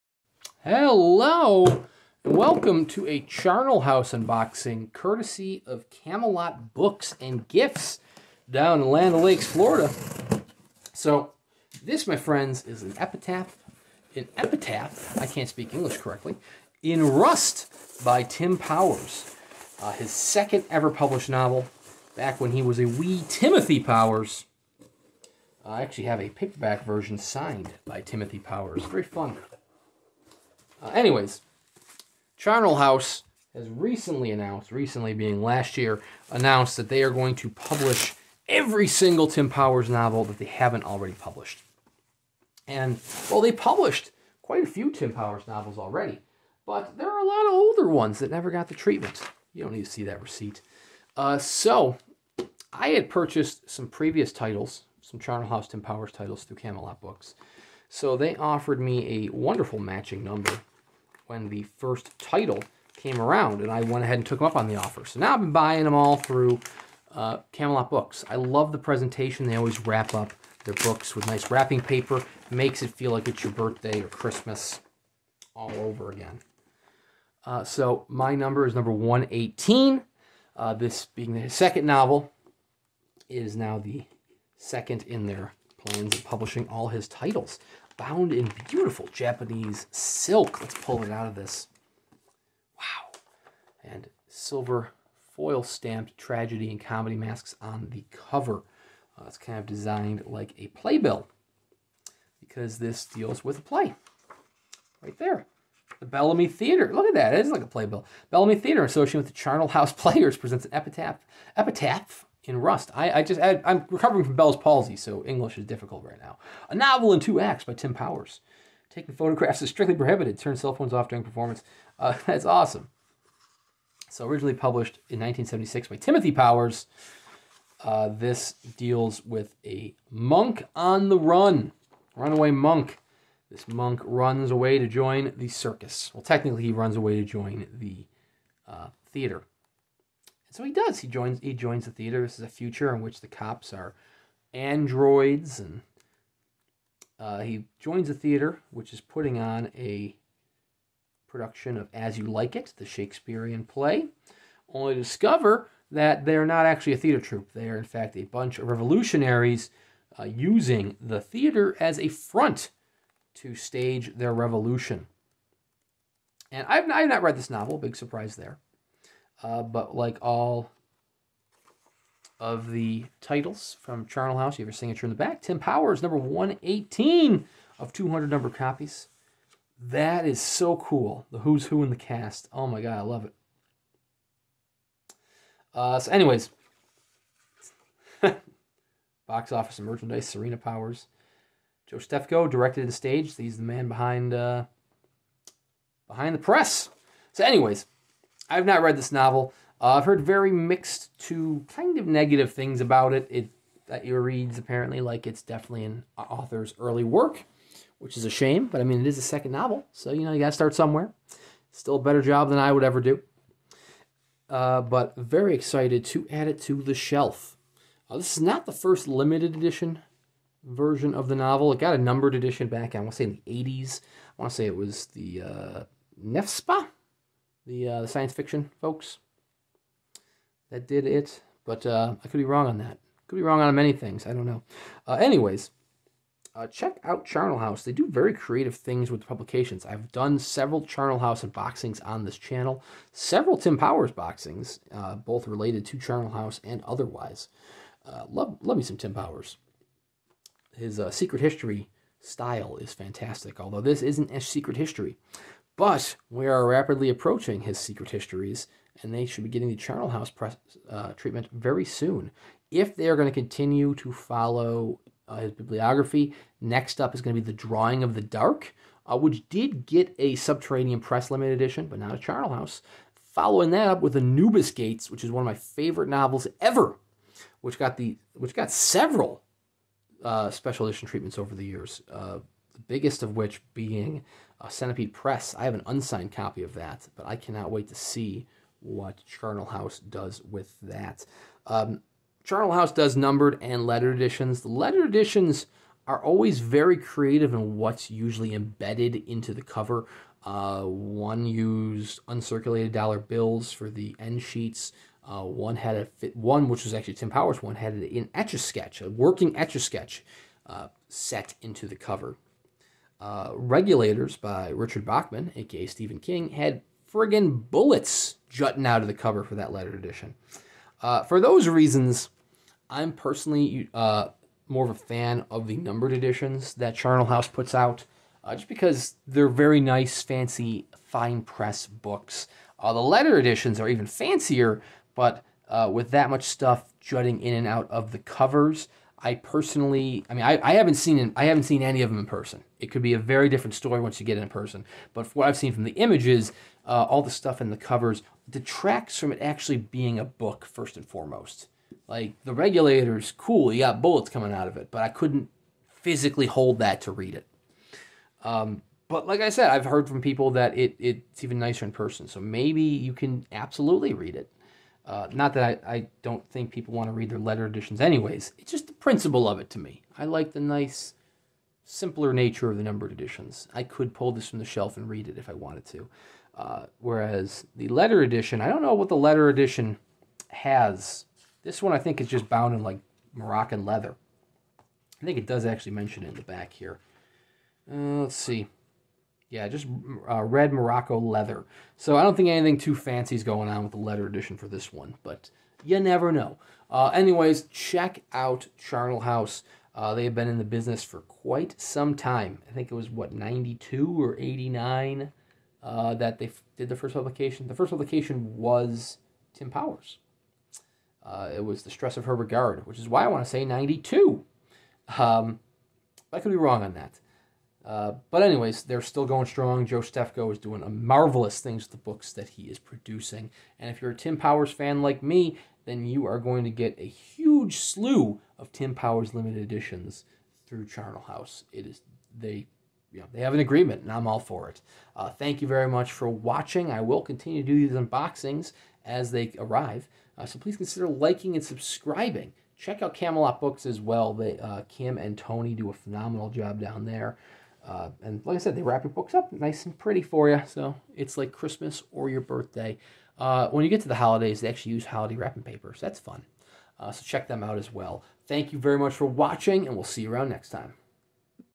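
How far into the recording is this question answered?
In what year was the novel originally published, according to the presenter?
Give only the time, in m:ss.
2:05.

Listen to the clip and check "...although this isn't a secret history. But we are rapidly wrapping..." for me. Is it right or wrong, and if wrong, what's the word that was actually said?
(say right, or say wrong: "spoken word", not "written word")
wrong: "approaching", not "wrapping".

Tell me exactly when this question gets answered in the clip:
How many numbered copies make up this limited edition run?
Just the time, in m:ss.
2:57.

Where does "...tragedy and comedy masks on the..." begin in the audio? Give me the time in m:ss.
1:36.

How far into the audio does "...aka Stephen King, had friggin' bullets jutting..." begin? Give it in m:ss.
5:15.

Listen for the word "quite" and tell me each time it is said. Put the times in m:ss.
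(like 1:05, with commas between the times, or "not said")
0:44, 6:41.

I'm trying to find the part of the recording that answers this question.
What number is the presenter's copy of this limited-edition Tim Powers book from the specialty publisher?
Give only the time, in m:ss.
1:18.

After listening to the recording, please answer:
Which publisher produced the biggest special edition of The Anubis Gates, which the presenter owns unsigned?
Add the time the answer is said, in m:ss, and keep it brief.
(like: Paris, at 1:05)
Centipede Press, at 4:44.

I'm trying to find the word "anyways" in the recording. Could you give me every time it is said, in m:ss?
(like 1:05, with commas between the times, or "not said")
0:30, 3:06, 3:17, 3:55, 6:08, 6:37, 6:58.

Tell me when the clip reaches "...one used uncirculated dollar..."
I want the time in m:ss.
5:00.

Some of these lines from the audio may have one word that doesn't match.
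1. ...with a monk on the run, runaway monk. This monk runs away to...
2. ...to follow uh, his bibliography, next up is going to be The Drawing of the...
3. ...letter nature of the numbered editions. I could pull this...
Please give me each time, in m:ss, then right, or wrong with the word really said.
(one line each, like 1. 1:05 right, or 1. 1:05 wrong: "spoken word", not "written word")
1. 2:09 right
2. 4:23 right
3. 6:11 wrong: "simpler", not "letter".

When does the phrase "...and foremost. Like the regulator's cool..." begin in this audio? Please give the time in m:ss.
5:50.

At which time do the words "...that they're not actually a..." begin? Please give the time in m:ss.
2:35.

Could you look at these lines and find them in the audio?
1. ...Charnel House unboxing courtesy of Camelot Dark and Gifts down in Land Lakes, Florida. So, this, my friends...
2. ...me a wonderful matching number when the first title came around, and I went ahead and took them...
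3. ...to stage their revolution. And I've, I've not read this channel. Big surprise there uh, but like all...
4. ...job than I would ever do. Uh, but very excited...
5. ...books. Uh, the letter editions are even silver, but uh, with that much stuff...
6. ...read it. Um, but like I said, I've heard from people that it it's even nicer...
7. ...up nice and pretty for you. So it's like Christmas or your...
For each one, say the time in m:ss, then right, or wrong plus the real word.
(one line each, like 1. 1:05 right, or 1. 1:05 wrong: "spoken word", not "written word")
1. 0:03 wrong: "Books", not "Dark"
2. 0:58 right
3. 2:43 wrong: "novel", not "channel"
4. 3:32 right
5. 5:31 wrong: "fancier", not "silver"
6. 5:57 right
7. 7:29 right.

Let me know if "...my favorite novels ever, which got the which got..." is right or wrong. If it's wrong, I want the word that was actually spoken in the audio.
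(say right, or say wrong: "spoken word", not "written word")
right.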